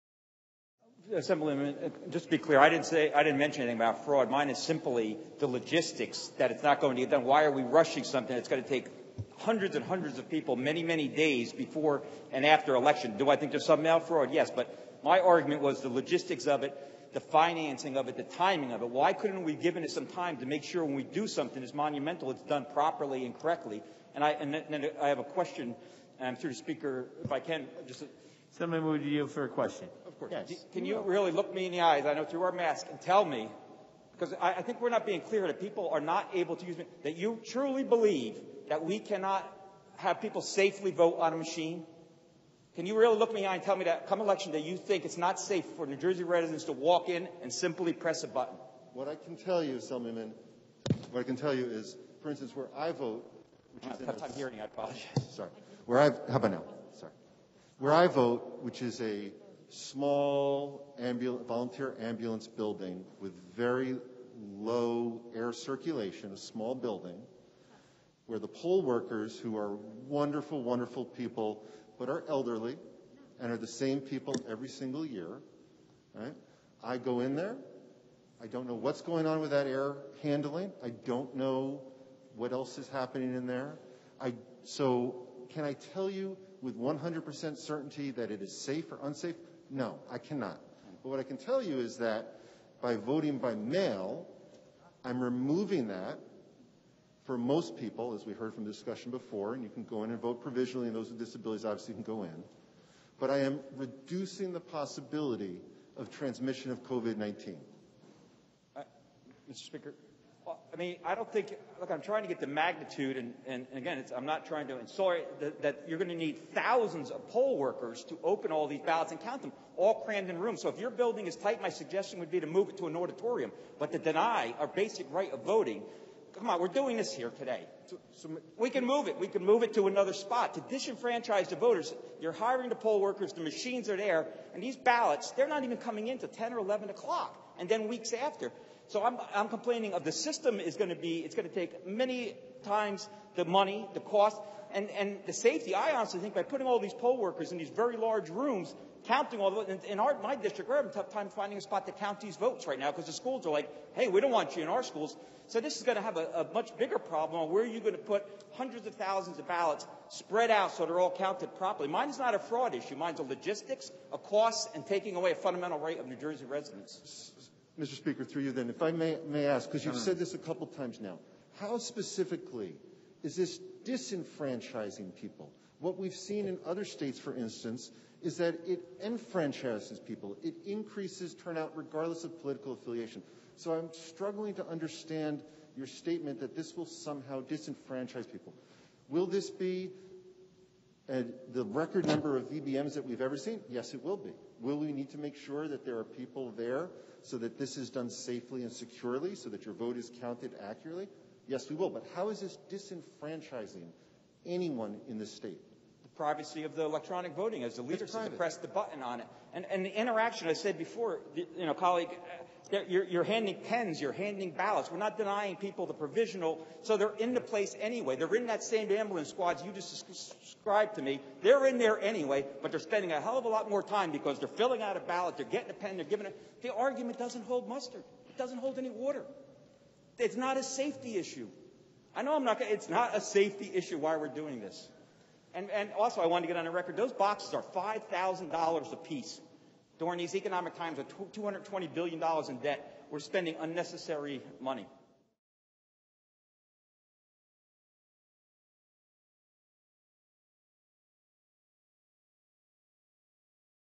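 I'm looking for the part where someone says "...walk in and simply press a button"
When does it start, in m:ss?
0:46.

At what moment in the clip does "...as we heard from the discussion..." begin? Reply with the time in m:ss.
1:38.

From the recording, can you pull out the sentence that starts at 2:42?
Mine's a logistics, a cost, and taking away a fundamental right of New Jersey residents.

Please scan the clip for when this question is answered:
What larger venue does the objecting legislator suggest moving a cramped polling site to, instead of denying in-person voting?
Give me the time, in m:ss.
2:02.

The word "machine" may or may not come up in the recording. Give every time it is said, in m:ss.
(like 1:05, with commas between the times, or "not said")
0:41, 2:13.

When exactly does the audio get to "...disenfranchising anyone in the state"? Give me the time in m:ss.
3:22.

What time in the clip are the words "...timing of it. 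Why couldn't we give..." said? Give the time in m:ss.
0:18.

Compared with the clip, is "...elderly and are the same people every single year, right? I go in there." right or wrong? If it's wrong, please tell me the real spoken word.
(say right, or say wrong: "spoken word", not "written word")
right.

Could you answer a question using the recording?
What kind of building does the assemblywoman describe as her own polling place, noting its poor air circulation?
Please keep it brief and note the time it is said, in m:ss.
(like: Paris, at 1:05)
volunteer ambulance building, at 1:01.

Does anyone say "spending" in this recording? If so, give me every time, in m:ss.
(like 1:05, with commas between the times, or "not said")
3:42, 4:03.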